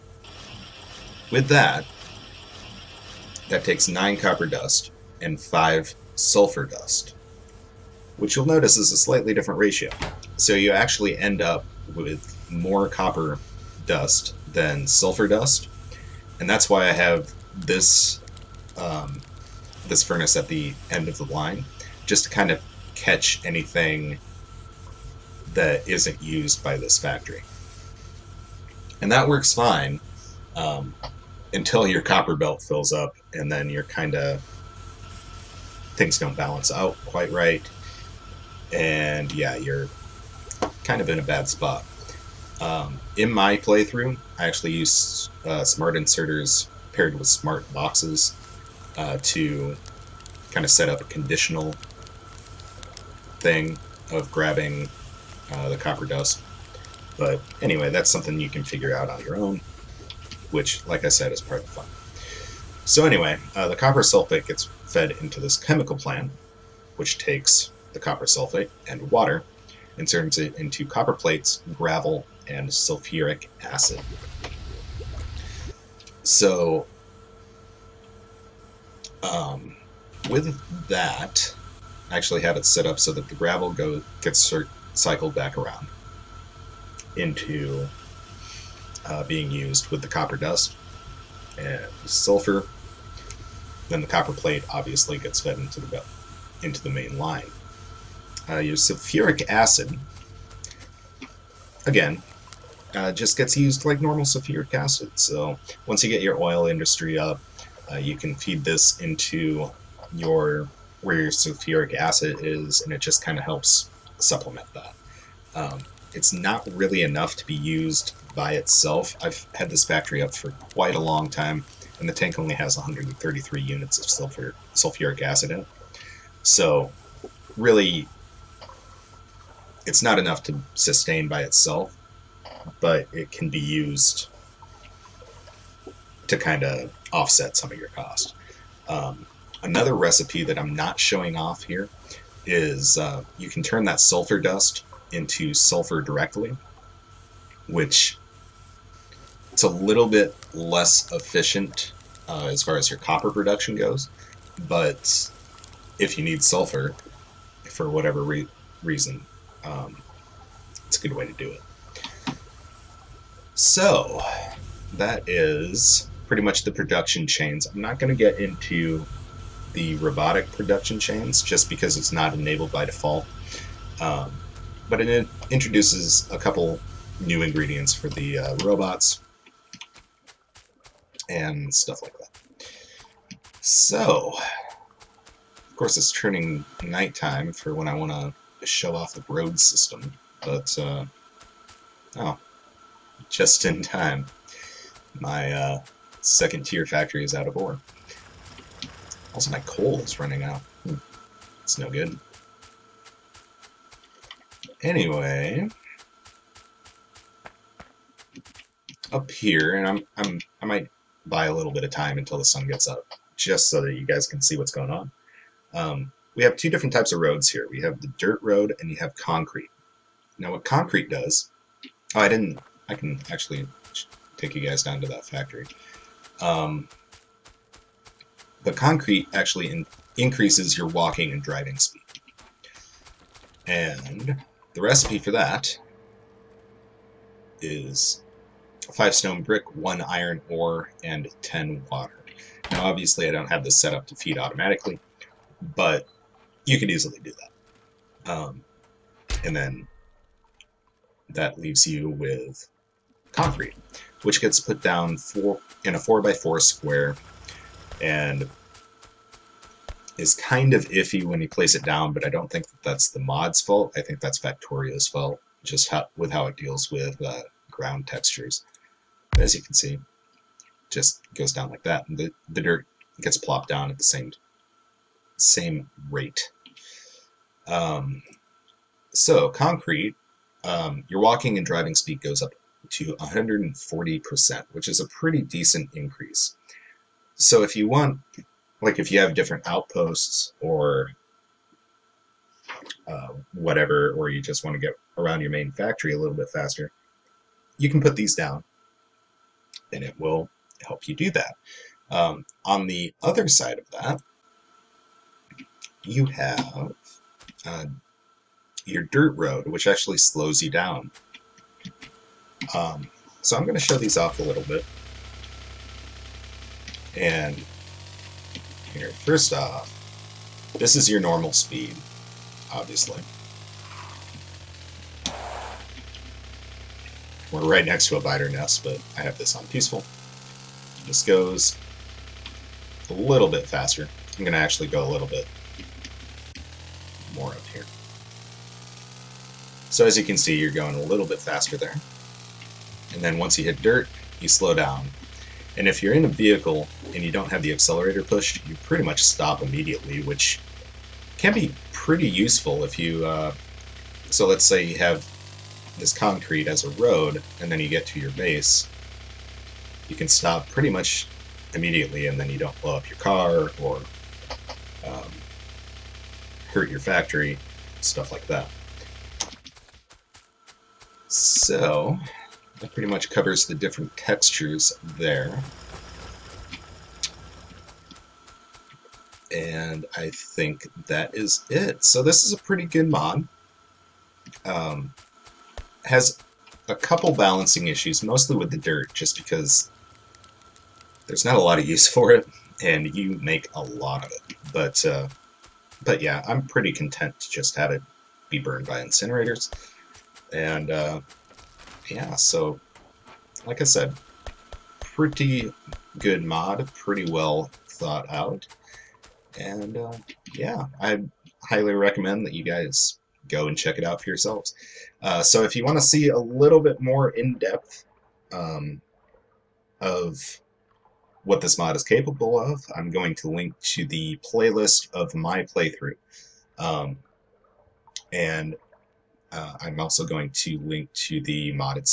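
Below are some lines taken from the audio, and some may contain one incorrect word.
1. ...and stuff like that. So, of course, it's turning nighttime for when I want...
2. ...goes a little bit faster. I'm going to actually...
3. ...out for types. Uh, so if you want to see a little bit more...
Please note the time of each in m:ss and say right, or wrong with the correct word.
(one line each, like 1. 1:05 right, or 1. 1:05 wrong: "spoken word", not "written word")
1. 3:01 right
2. 5:31 right
3. 6:54 wrong: "yourselves", not "types".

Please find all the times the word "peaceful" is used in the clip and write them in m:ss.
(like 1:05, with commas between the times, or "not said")
5:29.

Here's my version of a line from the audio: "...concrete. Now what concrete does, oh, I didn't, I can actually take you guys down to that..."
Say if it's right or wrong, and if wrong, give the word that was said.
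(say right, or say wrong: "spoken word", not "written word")
right.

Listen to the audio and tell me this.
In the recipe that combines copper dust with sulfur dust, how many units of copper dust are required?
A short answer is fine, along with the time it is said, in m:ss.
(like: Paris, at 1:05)
9, at 0:03.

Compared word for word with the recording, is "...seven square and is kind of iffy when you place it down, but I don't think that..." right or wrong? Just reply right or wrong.
wrong.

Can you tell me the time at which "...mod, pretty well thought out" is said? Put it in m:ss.
6:46.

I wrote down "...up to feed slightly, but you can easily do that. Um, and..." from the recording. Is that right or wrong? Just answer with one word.
wrong.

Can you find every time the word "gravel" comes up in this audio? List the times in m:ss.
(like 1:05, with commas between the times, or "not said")
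1:11, 1:23.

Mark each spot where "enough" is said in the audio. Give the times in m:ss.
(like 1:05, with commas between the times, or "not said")
1:57, 2:10.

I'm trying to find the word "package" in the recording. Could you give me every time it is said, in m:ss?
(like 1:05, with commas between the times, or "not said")
not said.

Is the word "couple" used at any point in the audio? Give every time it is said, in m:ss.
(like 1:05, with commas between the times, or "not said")
2:56, 6:26.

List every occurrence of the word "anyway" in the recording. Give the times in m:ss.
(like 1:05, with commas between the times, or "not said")
0:57, 1:03, 3:24.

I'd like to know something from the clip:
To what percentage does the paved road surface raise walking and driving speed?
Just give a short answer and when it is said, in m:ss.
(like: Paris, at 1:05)
140%, at 4:43.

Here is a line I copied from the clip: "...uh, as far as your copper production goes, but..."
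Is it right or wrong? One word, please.
right.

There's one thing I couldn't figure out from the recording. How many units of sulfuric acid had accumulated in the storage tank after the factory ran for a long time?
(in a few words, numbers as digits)
133.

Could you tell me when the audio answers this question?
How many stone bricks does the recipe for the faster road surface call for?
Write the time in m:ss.
3:58.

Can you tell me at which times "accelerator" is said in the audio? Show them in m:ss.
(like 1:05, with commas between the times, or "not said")
5:47.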